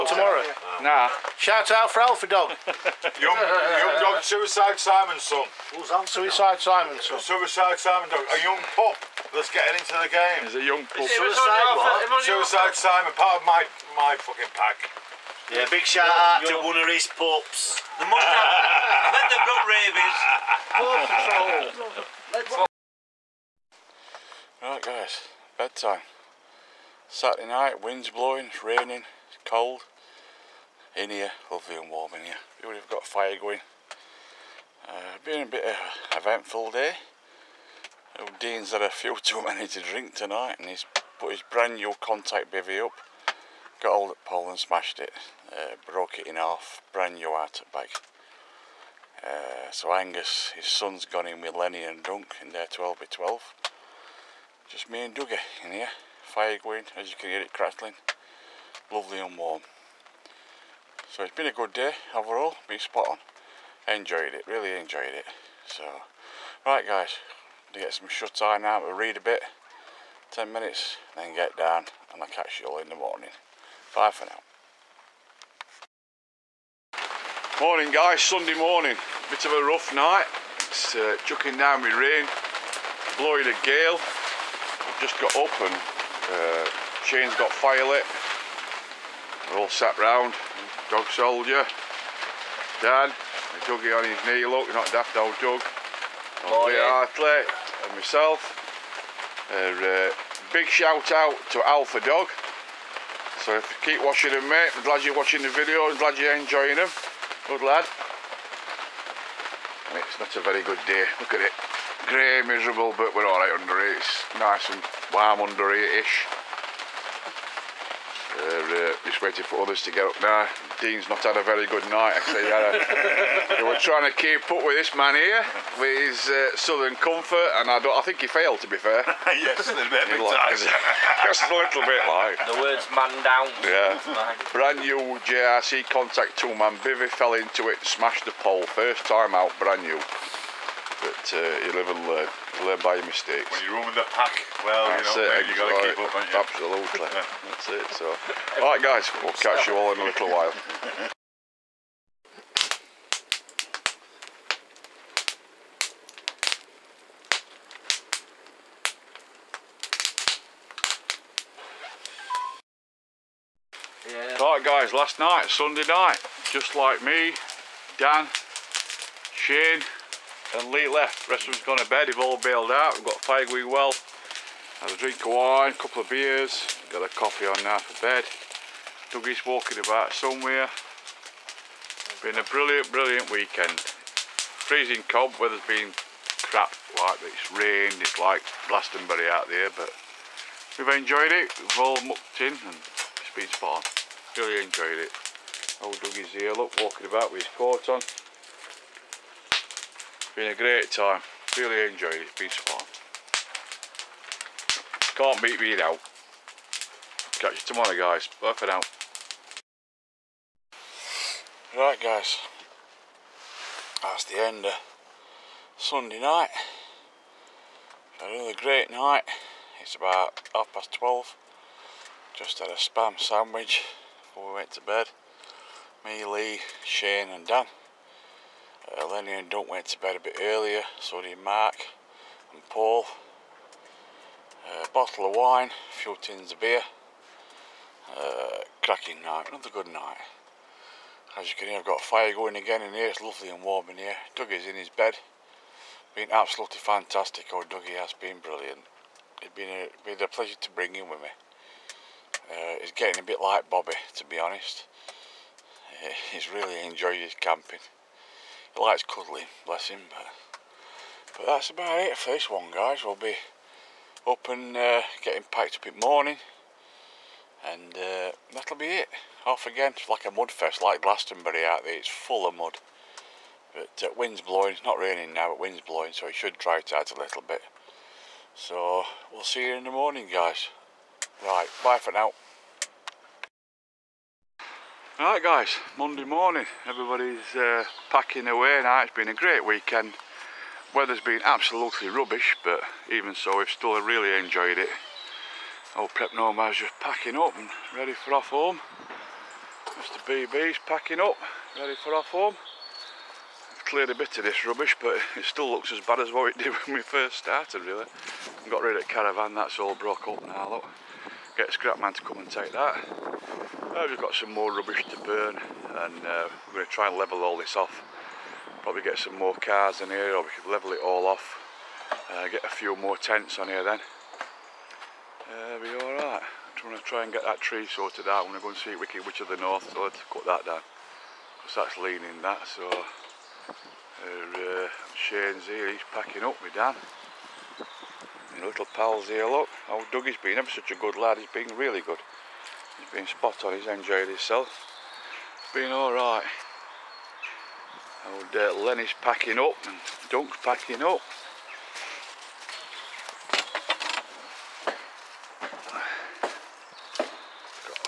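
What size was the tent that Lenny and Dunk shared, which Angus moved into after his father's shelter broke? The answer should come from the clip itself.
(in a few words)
12 by 12.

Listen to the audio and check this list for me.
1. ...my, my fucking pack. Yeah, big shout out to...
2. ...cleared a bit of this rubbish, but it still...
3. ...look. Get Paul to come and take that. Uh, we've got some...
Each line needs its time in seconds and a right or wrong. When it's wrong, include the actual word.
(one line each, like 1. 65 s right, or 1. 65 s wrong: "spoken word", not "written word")
1. 13 s right
2. 303 s right
3. 310 s wrong: "Scrapman", not "Paul".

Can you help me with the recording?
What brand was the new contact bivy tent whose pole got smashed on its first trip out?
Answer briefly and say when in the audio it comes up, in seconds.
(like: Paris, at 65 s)
JRC, at 135 s.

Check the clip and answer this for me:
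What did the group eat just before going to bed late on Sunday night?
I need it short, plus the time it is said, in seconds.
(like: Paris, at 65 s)
Spam sandwich, at 222 s.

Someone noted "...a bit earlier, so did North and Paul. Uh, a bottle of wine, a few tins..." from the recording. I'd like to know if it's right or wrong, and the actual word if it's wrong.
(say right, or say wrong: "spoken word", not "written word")
wrong: "Mark", not "North".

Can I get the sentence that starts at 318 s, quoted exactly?
Probably get some more cars in here or we could level it all off.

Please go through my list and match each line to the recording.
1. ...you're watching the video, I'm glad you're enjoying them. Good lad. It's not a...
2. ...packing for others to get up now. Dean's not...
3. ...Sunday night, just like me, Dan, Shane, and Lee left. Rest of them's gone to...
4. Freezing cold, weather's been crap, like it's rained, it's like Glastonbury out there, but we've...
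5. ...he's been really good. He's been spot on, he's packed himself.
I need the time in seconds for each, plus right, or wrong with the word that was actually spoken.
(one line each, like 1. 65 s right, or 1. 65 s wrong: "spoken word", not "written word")
1. 105 s right
2. 119 s wrong: "waiting", not "packing"
3. 165 s right
4. 183 s right
5. 341 s wrong: "enjoyed", not "packed".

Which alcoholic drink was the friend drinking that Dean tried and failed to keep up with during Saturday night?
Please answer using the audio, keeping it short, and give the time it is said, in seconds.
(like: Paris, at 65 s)
Southern Comfort, at 126 s.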